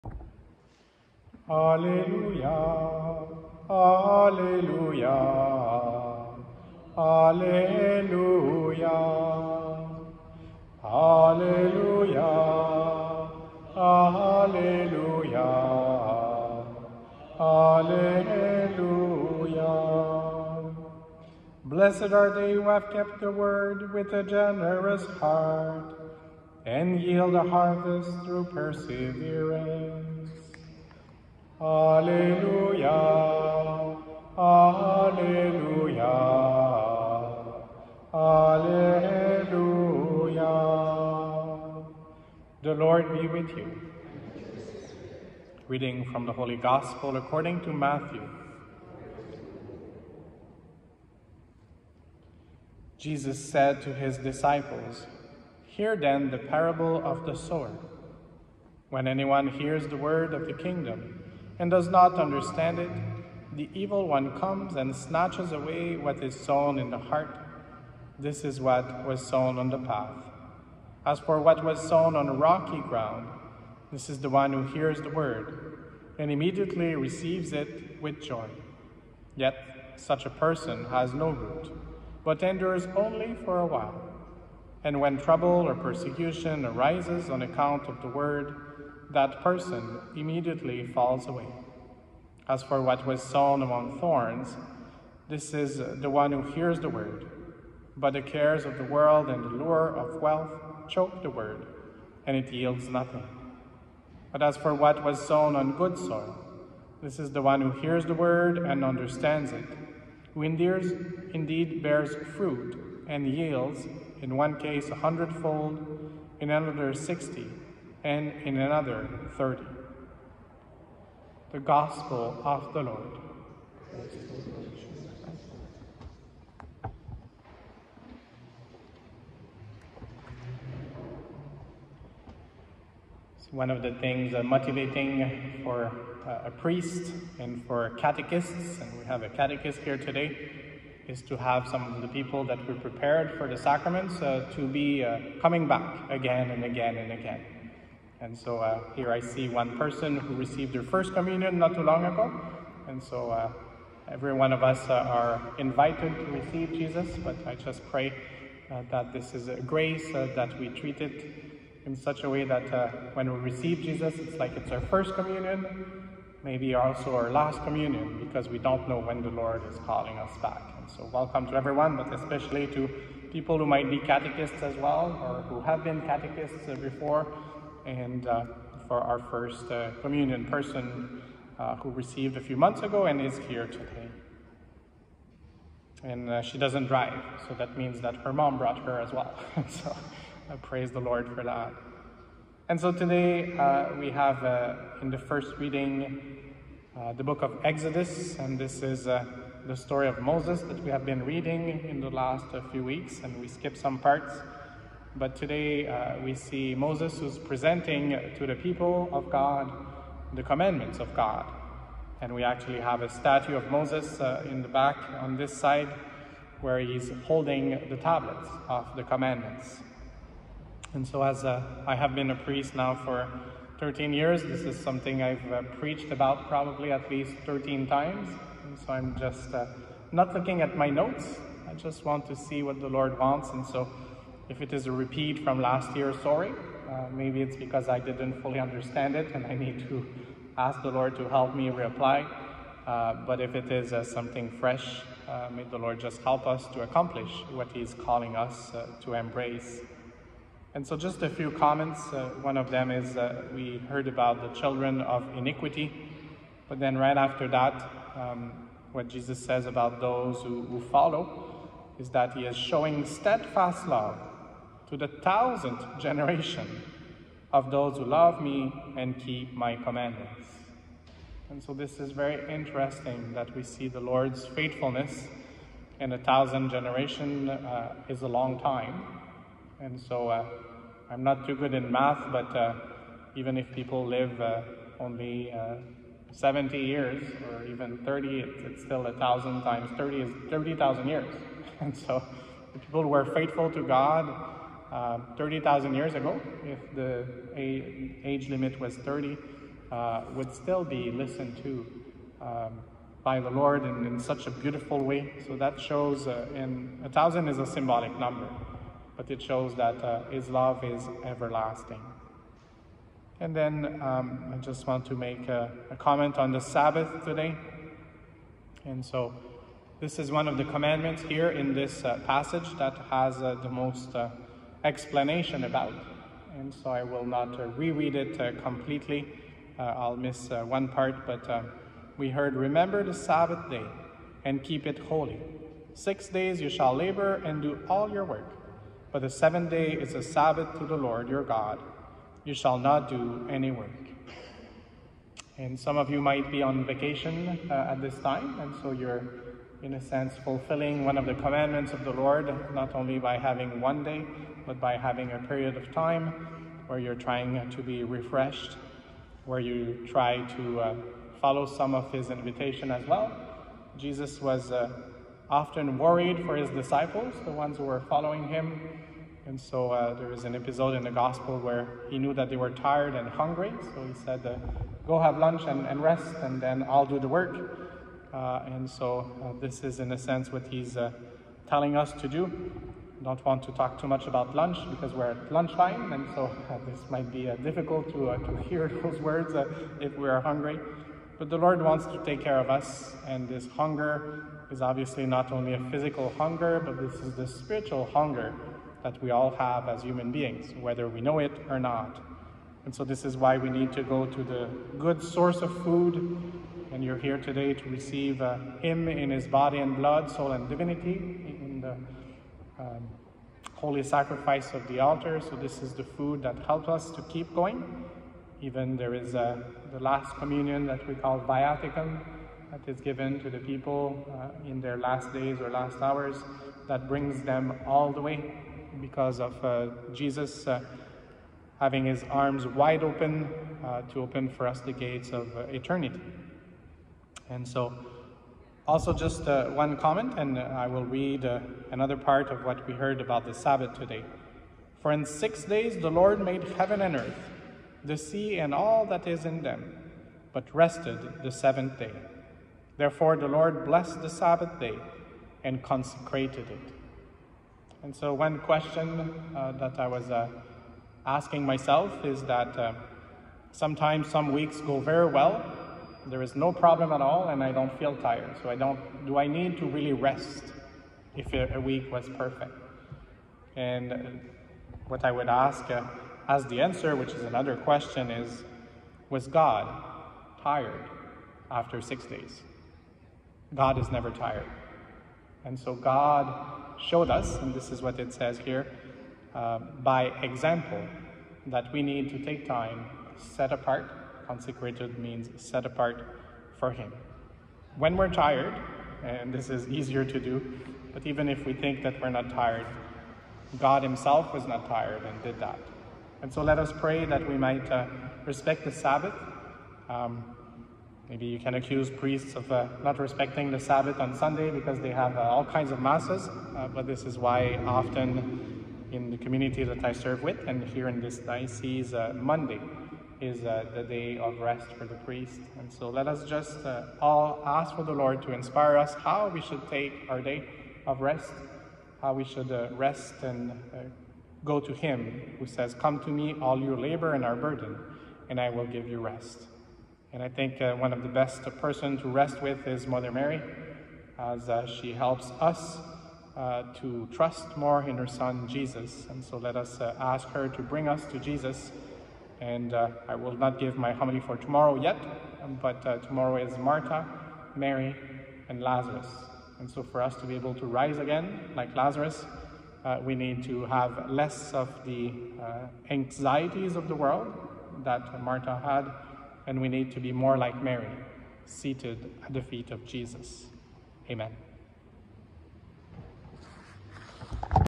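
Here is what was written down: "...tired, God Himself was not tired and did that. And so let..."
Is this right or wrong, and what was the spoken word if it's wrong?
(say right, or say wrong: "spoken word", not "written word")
right.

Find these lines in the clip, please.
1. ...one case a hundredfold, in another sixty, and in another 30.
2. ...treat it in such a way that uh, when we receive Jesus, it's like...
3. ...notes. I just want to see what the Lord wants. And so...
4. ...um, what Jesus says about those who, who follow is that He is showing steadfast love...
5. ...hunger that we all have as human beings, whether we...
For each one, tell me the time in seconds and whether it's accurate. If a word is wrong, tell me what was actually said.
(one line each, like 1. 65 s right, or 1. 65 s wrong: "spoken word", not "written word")
1. 114 s right
2. 160 s right
3. 230 s right
4. 258 s right
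5. 398 s right.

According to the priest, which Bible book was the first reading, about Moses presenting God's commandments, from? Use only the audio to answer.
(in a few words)
Exodus.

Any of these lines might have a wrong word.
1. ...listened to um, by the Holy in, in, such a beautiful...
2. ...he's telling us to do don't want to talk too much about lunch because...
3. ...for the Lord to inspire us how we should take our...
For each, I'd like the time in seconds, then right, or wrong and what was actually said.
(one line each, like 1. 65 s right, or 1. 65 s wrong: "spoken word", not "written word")
1. 301 s wrong: "Lord", not "Holy"
2. 380 s right
3. 527 s right.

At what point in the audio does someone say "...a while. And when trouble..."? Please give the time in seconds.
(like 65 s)
83 s.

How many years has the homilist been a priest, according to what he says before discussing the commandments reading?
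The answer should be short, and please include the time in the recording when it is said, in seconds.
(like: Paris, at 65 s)
13, at 223 s.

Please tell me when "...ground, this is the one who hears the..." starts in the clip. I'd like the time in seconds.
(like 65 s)
72 s.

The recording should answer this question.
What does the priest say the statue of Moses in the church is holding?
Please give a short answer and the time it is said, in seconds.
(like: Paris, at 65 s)
The tablets of the commandments, at 217 s.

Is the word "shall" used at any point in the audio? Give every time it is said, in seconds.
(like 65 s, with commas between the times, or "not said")
336 s, 342 s.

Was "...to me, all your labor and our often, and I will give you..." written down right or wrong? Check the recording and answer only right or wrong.
wrong.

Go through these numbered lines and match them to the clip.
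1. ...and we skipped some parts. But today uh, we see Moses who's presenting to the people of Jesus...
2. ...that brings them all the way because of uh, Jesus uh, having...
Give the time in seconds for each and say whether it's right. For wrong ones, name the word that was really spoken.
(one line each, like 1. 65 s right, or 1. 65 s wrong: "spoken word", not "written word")
1. 203 s wrong: "God", not "Jesus"
2. 426 s right.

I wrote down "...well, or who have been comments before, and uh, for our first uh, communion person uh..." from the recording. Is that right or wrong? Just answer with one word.
wrong.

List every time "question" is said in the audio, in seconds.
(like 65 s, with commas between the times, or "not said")
458 s, 477 s.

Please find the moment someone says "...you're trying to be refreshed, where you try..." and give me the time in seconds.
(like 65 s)
356 s.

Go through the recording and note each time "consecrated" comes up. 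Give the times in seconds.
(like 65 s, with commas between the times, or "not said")
455 s, 494 s.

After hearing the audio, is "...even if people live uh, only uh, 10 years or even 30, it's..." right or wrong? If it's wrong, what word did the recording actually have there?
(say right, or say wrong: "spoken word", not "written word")
wrong: "70", not "10".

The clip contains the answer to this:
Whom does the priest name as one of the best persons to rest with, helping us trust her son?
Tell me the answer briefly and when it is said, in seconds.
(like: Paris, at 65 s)
Mother Mary, at 543 s.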